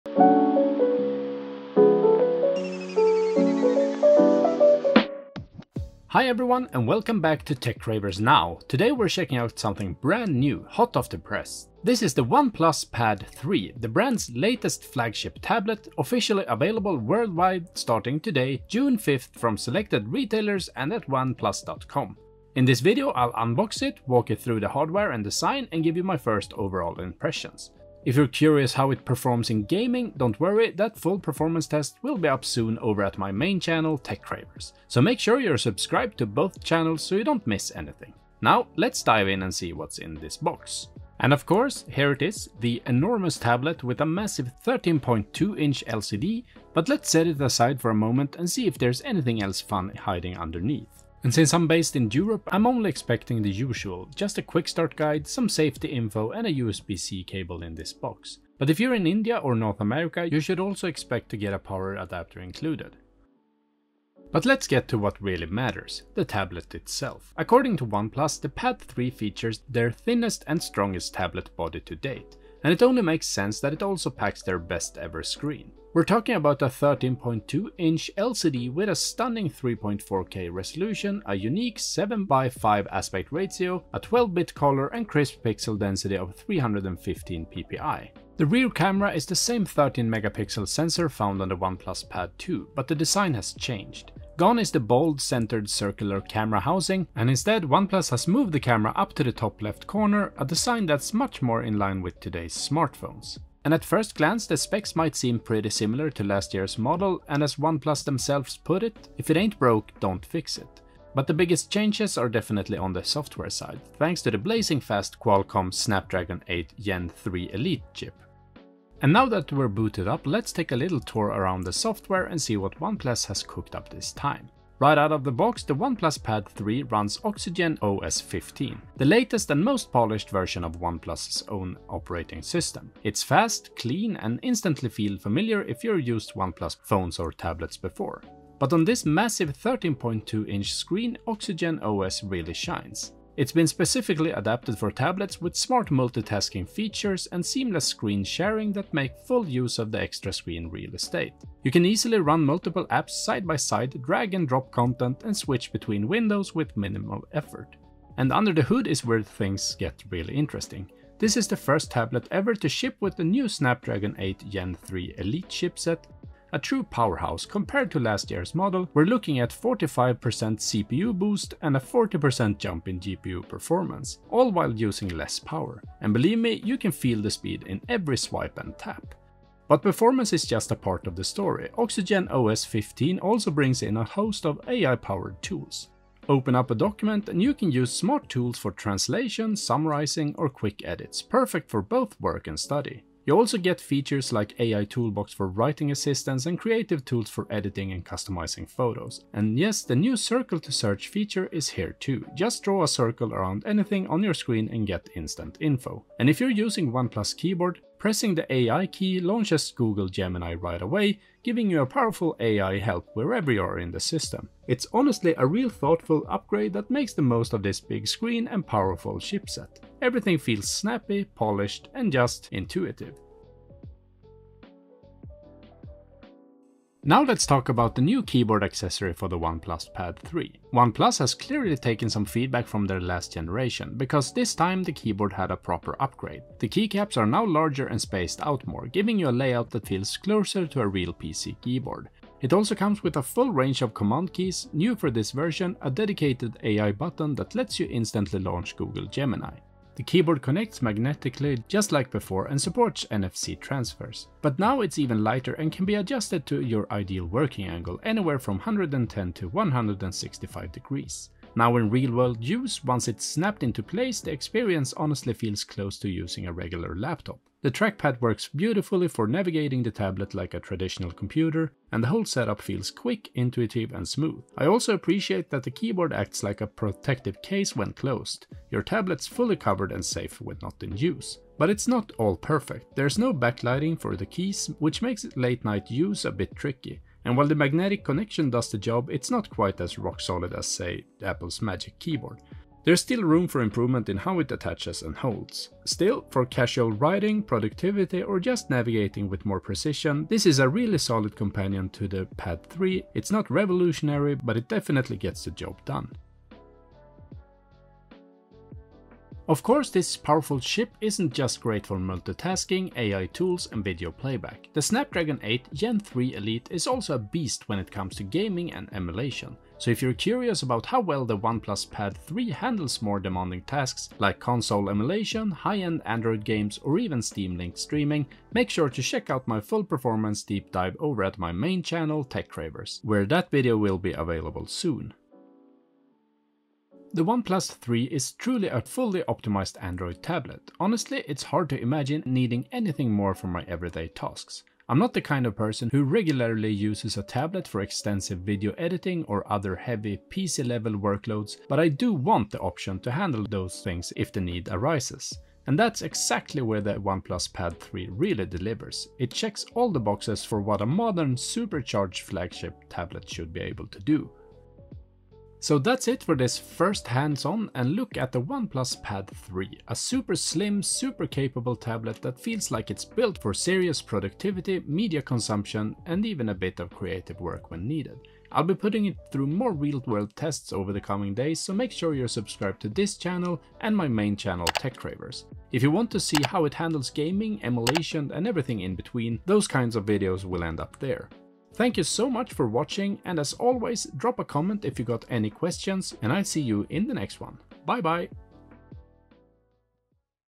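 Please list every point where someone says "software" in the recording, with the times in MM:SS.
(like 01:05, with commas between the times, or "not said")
01:53, 02:01.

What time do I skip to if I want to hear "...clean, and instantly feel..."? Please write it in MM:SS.
02:13.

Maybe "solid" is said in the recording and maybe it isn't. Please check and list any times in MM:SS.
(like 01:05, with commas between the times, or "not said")
04:50, 05:00.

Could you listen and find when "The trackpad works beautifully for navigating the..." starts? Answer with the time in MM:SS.
04:27.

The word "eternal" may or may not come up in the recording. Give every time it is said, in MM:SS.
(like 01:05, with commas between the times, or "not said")
not said.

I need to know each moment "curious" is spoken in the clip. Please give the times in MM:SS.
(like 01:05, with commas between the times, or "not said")
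00:28, 05:20.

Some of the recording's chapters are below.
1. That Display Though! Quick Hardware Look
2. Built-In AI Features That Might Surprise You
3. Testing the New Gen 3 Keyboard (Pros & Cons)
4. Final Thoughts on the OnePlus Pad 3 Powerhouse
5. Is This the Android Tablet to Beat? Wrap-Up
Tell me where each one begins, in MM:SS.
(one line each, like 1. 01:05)
1. 01:03
2. 02:59
3. 03:46
4. 05:37
5. 06:05.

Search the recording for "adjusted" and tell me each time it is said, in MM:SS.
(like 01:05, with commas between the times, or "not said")
04:15.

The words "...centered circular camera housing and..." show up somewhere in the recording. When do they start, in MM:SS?
01:35.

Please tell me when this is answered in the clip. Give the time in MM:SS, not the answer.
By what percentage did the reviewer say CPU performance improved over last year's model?
02:49.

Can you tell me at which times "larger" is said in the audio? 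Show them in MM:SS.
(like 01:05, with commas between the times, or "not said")
03:57.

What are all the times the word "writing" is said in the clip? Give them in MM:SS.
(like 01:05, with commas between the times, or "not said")
03:15, 04:56.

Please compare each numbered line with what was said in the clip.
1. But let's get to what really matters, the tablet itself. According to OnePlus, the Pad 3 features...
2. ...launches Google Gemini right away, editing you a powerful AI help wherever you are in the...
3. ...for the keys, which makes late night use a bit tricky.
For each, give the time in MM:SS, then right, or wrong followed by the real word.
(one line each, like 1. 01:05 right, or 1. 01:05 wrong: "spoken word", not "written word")
1. 01:04 right
2. 03:29 wrong: "giving", not "editing"
3. 04:43 right.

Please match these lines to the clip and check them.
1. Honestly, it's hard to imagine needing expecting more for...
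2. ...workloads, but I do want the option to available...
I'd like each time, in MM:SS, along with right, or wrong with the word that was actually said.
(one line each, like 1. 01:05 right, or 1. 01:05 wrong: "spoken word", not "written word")
1. 05:40 wrong: "anything", not "expecting"
2. 05:50 wrong: "handle", not "available".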